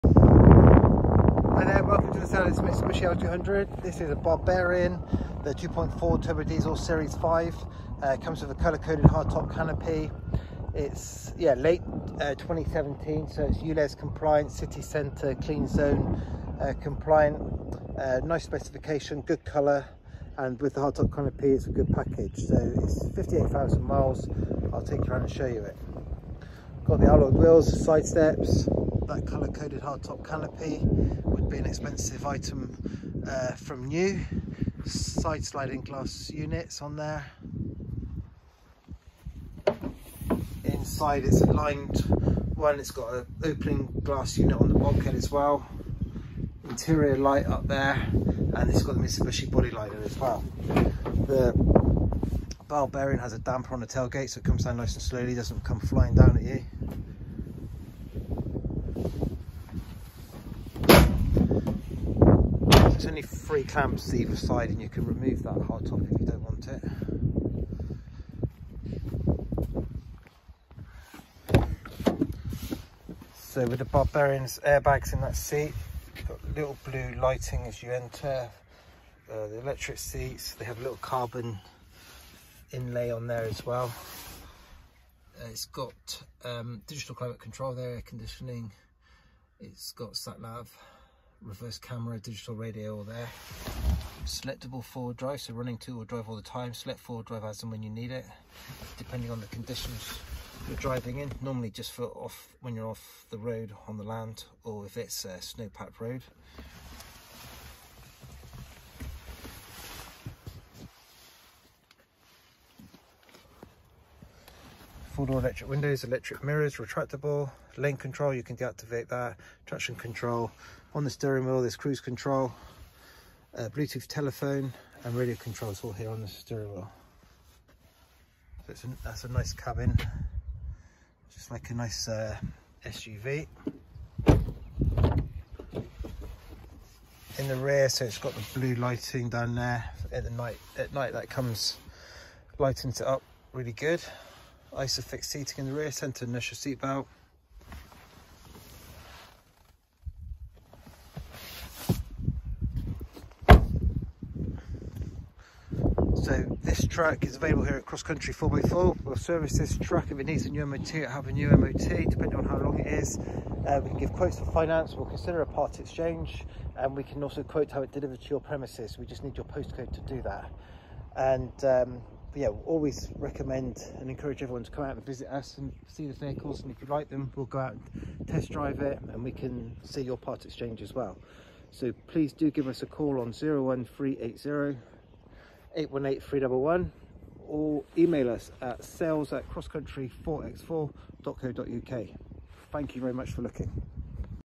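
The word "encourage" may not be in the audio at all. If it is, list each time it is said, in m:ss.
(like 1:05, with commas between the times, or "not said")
2:54.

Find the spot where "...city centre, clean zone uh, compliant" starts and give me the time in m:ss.
0:14.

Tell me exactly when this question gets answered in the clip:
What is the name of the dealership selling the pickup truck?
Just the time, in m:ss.
2:37.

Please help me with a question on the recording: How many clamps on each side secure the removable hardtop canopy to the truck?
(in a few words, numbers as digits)
3.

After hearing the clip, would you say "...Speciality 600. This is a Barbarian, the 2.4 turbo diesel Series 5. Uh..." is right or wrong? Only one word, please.
wrong.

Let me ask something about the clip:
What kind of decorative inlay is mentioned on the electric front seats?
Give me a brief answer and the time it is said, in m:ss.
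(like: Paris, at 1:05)
Carbon, at 1:21.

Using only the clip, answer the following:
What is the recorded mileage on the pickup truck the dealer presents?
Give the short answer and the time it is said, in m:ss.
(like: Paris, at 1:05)
58,000 miles, at 0:23.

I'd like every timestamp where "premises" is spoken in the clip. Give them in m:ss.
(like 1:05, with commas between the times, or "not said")
2:48.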